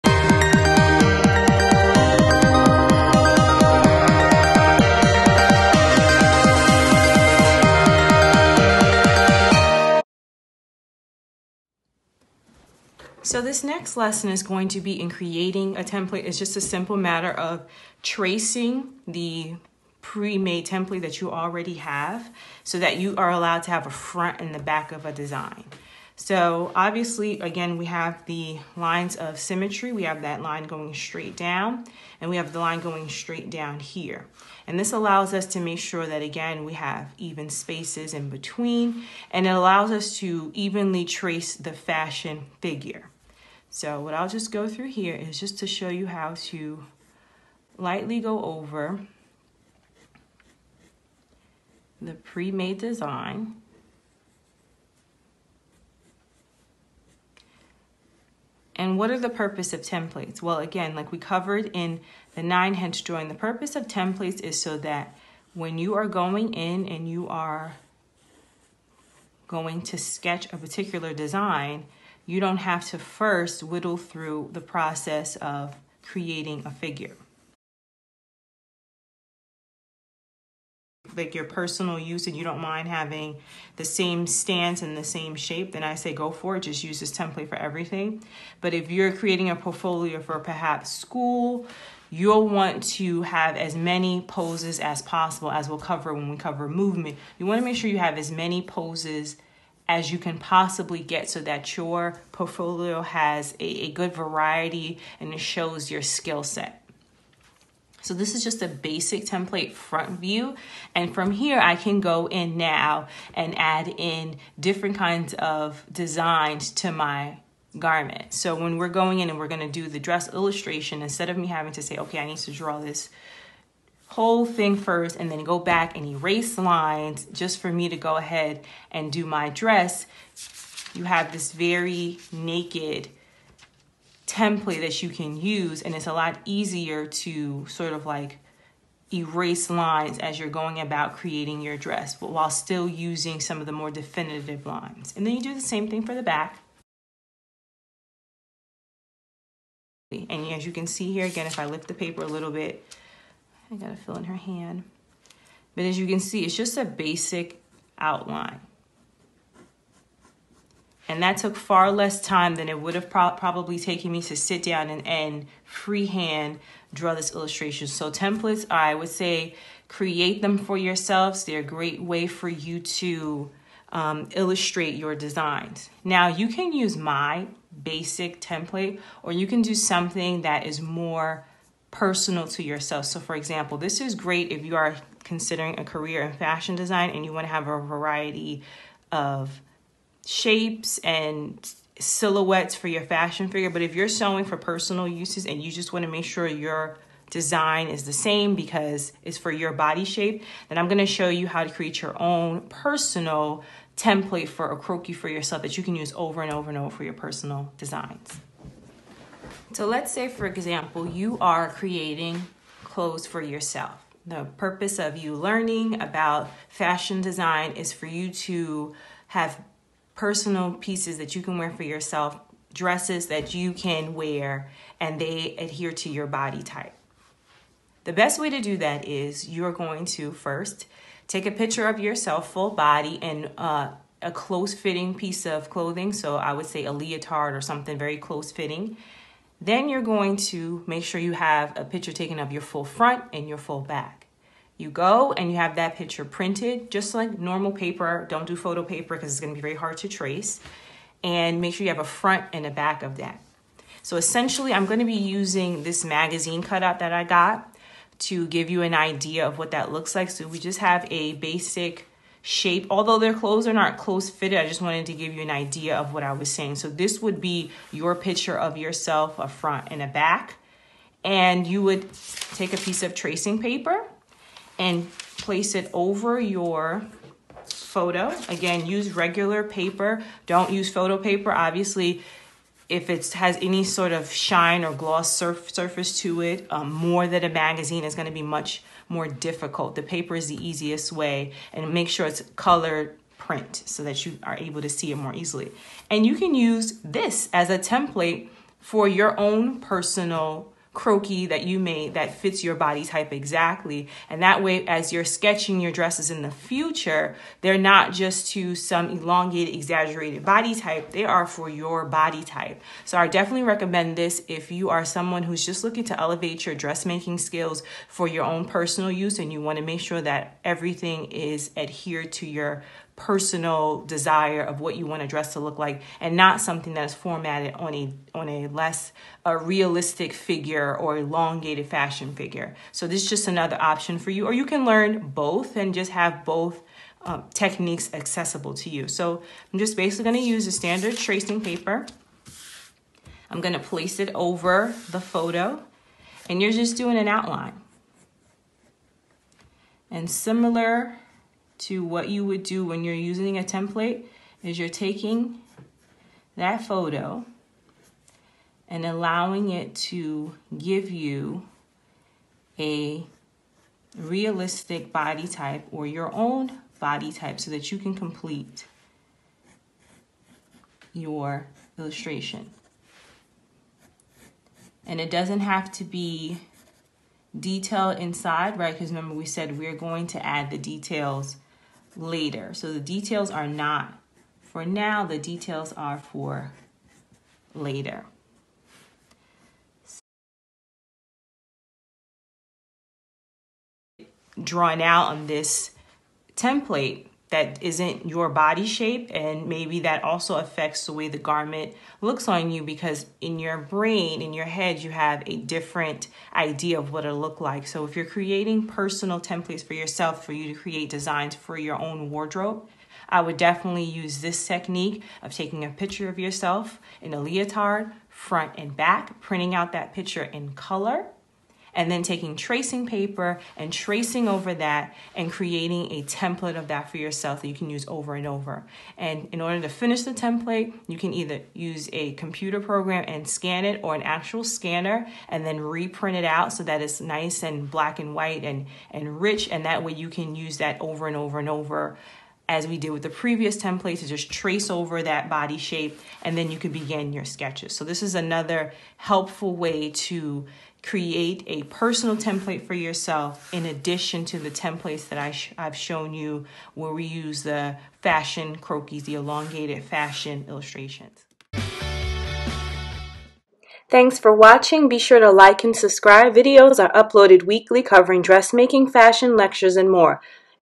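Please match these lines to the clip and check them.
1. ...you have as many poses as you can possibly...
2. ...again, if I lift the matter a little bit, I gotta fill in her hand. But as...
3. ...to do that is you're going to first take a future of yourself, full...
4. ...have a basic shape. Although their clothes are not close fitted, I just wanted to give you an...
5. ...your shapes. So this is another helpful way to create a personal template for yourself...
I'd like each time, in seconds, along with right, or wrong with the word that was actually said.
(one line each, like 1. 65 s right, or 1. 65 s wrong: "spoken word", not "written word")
1. 97 s right
2. 151 s wrong: "paper", not "matter"
3. 228 s wrong: "picture", not "future"
4. 260 s right
5. 447 s wrong: "sketches", not "shapes".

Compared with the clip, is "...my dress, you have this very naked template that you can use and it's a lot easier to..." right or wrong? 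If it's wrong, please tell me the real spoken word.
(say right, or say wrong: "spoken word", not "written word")
right.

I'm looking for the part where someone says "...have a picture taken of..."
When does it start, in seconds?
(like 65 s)
241 s.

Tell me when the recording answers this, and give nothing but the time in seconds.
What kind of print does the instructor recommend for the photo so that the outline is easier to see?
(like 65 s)
292 s.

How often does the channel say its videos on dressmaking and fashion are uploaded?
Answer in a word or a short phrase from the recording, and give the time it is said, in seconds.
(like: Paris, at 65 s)
weekly, at 467 s.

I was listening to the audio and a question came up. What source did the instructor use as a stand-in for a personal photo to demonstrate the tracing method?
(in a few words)
magazine cutout.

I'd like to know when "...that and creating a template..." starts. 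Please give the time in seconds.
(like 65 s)
424 s.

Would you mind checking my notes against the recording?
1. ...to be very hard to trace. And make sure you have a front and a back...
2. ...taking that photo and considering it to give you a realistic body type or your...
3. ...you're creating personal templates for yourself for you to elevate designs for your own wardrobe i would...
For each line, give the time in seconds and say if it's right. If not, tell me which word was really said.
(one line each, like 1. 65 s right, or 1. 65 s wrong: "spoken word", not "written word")
1. 249 s right
2. 354 s wrong: "allowing", not "considering"
3. 408 s wrong: "create", not "elevate".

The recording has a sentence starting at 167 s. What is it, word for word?
So templates, I would say create them for yourselves.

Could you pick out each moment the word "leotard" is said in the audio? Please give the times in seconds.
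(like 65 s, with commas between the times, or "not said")
236 s, 417 s.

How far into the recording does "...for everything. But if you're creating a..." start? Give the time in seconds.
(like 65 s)
87 s.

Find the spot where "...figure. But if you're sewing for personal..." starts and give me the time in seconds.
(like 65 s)
193 s.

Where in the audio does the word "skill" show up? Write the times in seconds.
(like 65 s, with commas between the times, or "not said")
106 s, 317 s.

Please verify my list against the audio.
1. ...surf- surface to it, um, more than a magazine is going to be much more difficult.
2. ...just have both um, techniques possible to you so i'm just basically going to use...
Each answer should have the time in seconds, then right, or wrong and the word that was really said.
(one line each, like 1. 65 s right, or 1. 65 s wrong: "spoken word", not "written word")
1. 285 s right
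2. 335 s wrong: "accessible", not "possible".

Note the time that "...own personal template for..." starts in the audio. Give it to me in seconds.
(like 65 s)
202 s.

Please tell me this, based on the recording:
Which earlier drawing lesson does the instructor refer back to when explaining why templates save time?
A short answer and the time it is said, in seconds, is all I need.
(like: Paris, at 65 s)
nine head drawing, at 62 s.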